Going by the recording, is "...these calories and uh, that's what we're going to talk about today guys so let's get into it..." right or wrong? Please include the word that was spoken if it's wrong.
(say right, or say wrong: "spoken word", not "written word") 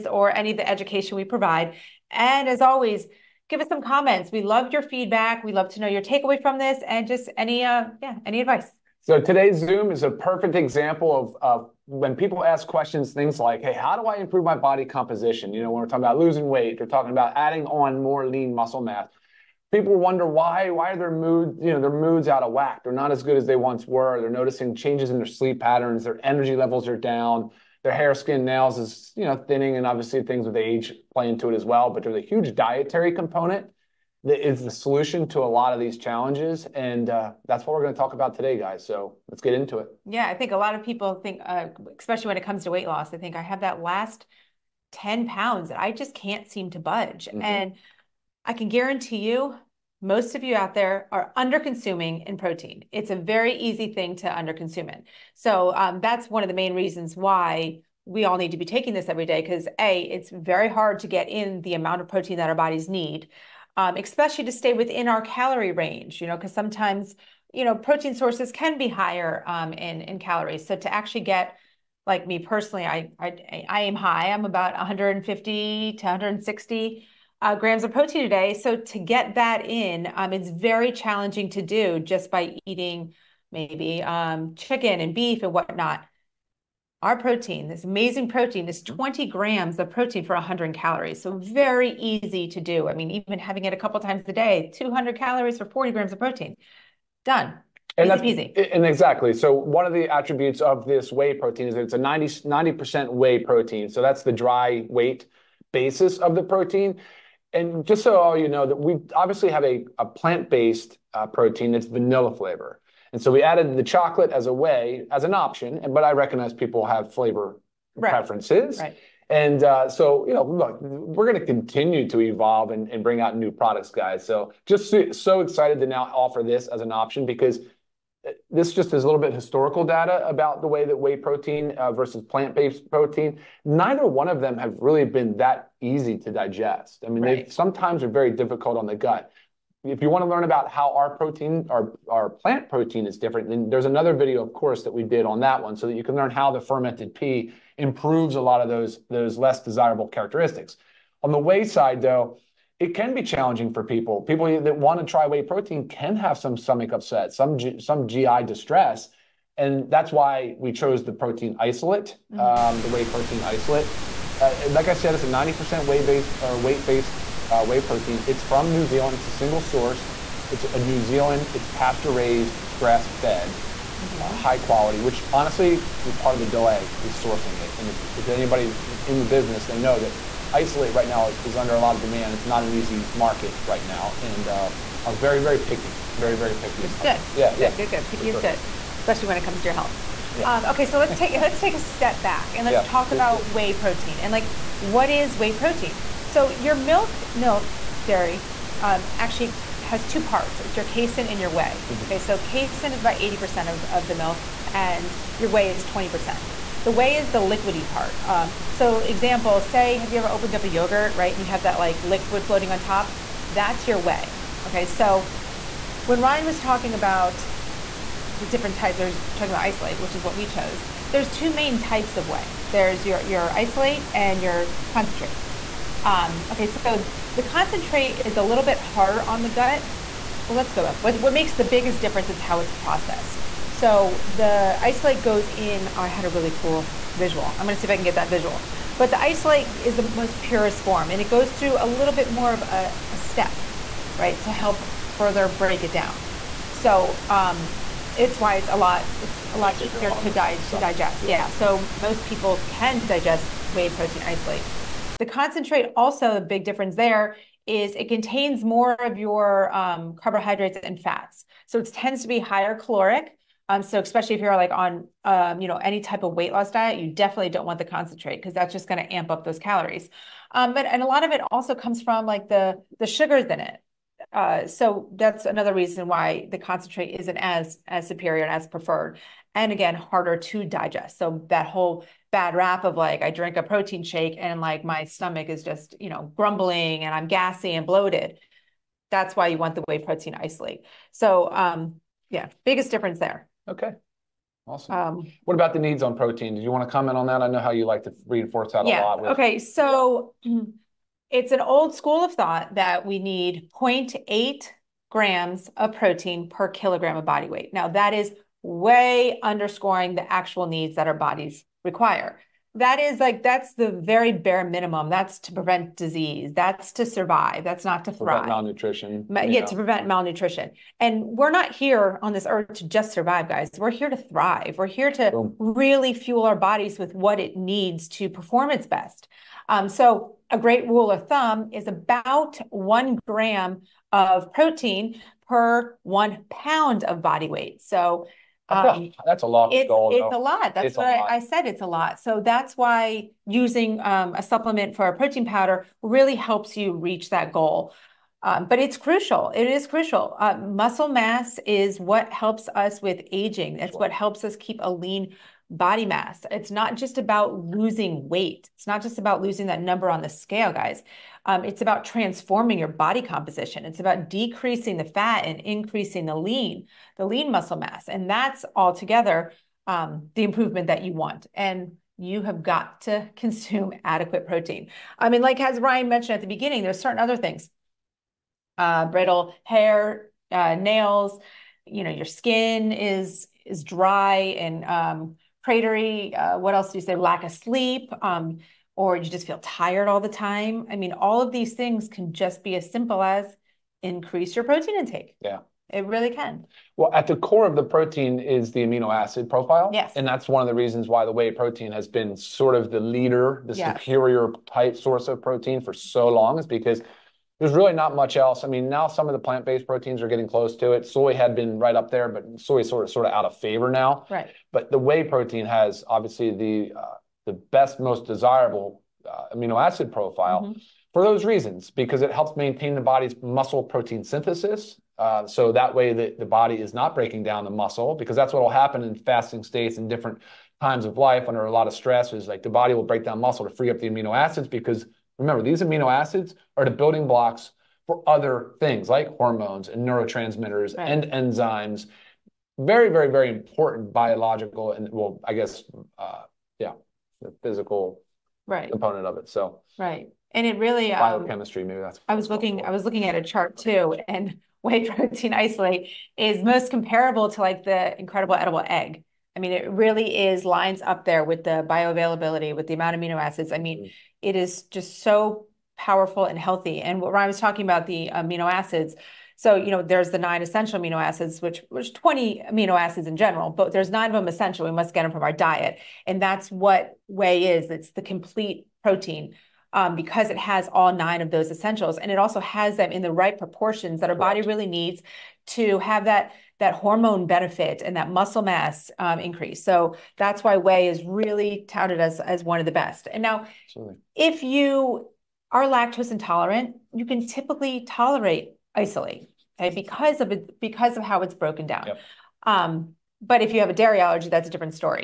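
wrong: "challenges", not "calories".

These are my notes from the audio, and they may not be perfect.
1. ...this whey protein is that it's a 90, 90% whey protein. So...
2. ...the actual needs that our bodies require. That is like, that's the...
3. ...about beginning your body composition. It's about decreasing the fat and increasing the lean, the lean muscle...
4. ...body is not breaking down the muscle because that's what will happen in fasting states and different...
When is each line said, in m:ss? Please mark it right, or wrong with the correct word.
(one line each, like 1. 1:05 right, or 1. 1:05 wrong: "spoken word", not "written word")
1. 1:40 right
2. 5:10 right
3. 6:01 wrong: "transforming", not "beginning"
4. 7:06 right.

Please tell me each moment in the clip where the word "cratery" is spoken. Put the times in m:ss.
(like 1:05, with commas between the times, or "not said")
6:25.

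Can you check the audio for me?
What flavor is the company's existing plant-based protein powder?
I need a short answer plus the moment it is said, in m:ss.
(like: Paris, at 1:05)
Vanilla, at 1:51.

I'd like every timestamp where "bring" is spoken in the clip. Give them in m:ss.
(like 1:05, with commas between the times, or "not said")
2:03.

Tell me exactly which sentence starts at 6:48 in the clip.
I mean, now some of the plant-based proteins are getting close to it.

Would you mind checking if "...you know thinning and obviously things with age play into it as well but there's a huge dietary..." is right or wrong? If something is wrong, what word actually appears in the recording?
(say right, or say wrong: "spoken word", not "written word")
right.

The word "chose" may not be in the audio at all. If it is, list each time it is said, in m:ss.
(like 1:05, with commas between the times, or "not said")
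2:40, 3:40.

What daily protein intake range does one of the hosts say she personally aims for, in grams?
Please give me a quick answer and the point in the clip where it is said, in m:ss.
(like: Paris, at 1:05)
150 to 160 grams, at 1:14.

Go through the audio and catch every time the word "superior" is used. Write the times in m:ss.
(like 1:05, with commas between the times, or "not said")
4:38, 6:44.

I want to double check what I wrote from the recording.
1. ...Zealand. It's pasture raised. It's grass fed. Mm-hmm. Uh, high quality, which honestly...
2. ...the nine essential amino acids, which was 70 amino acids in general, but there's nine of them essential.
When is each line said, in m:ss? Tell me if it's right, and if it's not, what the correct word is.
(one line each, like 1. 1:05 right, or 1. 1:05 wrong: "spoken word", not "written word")
1. 2:50 right
2. 7:50 wrong: "20", not "70".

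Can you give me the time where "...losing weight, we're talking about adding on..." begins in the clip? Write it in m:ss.
0:16.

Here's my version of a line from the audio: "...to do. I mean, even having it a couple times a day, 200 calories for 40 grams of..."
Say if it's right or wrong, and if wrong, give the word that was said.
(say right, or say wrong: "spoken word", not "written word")
right.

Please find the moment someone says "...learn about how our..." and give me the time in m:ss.
2:20.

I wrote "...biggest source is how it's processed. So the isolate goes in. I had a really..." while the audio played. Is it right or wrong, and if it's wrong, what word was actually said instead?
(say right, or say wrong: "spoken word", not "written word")
wrong: "difference", not "source".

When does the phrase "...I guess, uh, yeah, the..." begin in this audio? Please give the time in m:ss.
7:25.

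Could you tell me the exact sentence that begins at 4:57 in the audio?
I know how you like to reinforce that yeah, a lot.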